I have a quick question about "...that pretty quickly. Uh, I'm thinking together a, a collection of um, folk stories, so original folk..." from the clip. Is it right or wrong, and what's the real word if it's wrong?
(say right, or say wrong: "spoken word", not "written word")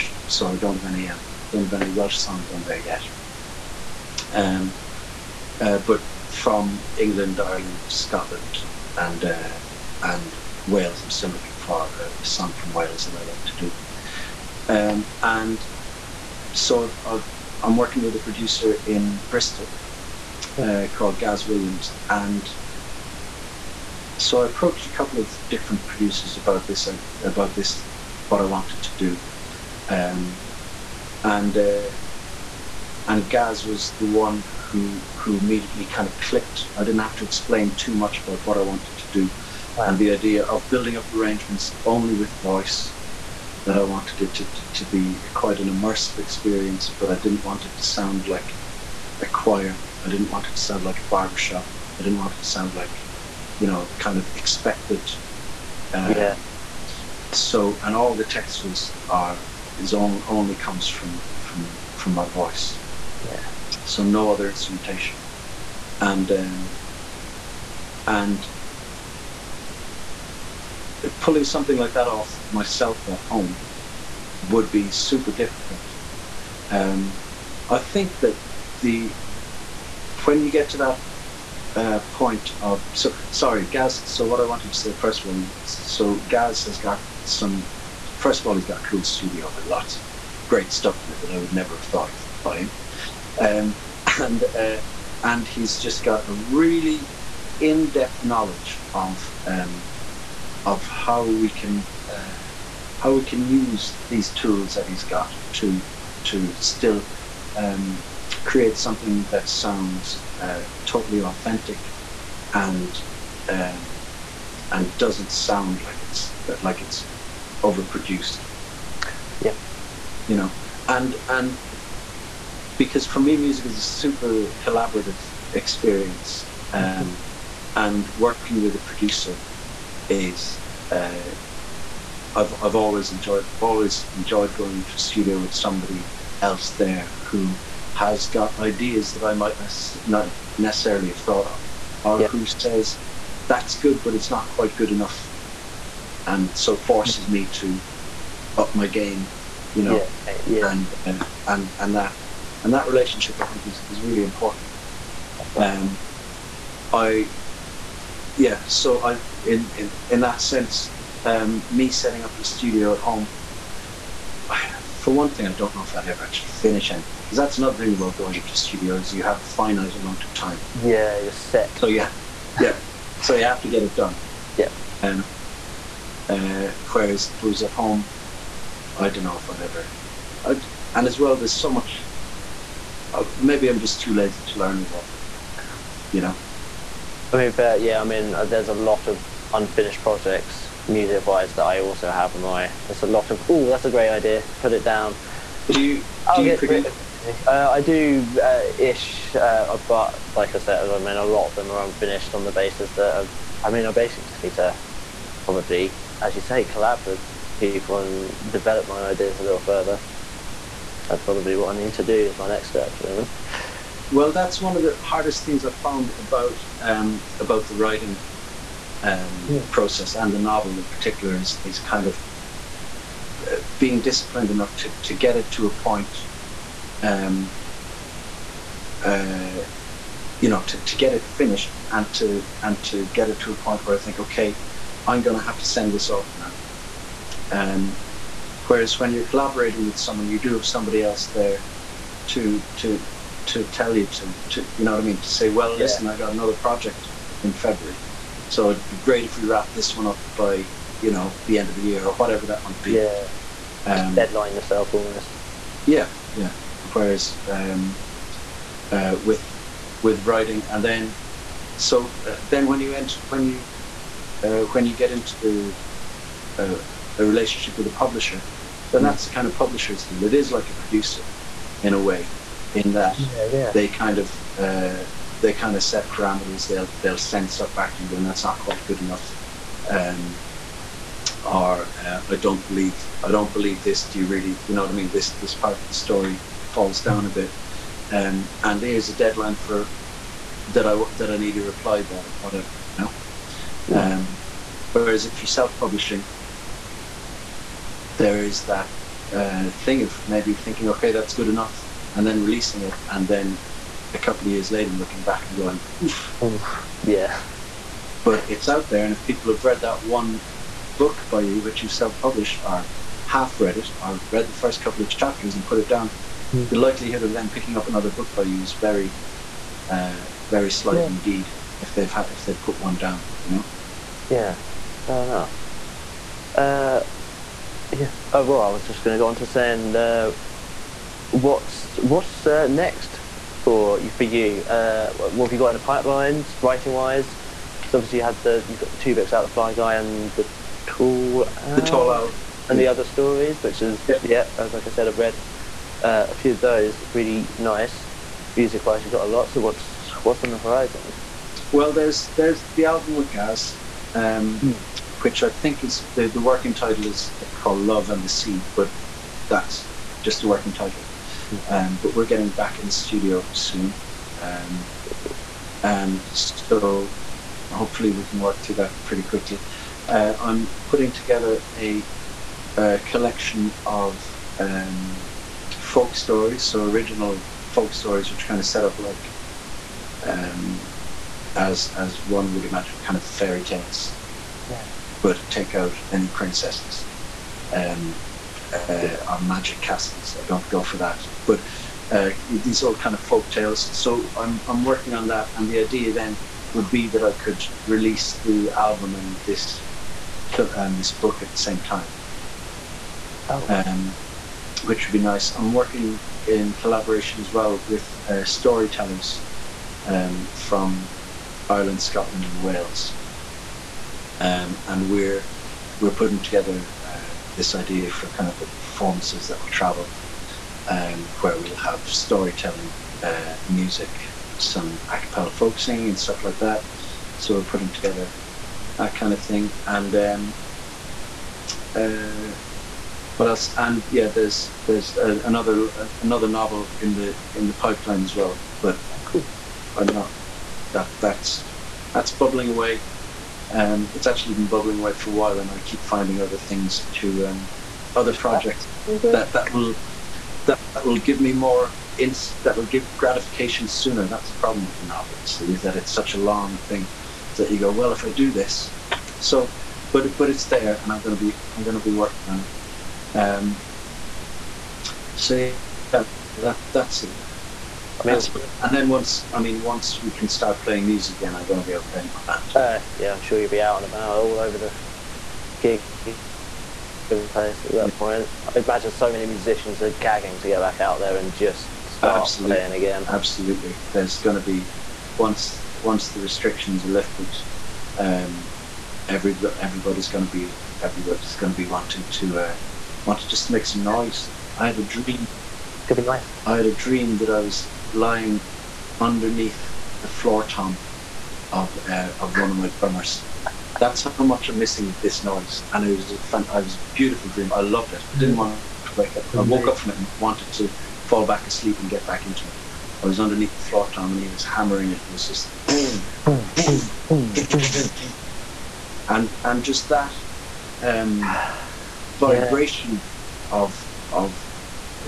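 wrong: "putting", not "thinking".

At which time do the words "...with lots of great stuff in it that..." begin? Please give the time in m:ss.
1:29.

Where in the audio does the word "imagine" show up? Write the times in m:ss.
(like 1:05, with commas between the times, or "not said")
6:22, 7:58.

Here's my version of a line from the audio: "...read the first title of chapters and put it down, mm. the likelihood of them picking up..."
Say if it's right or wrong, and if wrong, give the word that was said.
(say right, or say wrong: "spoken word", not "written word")
wrong: "couple", not "title".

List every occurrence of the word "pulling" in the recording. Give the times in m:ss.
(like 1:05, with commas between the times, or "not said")
1:11.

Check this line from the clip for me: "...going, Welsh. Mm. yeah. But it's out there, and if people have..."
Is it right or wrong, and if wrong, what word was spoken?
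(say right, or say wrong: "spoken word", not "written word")
wrong: "Oof", not "Welsh".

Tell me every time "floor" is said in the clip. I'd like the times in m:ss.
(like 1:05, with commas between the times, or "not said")
8:20, 8:33.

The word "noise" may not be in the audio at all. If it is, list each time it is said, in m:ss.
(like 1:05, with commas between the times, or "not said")
8:14, 8:25.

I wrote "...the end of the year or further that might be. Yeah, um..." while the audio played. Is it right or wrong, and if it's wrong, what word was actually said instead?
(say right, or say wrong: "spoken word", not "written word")
wrong: "whatever", not "further".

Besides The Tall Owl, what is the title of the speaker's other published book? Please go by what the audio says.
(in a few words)
The Fly Guy.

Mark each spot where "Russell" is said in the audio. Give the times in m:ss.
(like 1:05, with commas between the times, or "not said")
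not said.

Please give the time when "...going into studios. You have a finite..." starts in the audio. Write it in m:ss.
2:48.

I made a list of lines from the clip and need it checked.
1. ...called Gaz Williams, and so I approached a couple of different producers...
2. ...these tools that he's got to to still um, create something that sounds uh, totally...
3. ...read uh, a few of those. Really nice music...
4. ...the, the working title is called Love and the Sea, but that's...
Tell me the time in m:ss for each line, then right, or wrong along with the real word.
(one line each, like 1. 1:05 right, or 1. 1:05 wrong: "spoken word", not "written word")
1. 0:20 right
2. 1:44 right
3. 5:45 right
4. 5:56 right.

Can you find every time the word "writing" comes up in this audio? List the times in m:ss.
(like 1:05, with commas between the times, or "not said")
3:37, 4:20, 5:36.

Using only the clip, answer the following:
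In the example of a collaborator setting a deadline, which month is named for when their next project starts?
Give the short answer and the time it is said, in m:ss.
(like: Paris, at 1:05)
February, at 4:07.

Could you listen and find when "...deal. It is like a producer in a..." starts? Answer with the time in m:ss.
4:30.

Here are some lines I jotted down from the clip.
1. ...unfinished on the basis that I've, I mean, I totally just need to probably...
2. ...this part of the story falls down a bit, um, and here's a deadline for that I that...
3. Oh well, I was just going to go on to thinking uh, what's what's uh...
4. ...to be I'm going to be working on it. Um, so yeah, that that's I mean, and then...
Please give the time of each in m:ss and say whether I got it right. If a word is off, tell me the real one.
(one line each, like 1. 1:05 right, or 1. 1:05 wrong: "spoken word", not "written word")
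1. 3:21 wrong: "basically", not "totally"
2. 4:45 right
3. 5:28 wrong: "saying", not "thinking"
4. 7:41 right.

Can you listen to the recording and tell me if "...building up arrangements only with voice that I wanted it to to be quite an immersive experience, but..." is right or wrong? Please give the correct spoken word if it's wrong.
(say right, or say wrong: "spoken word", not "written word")
right.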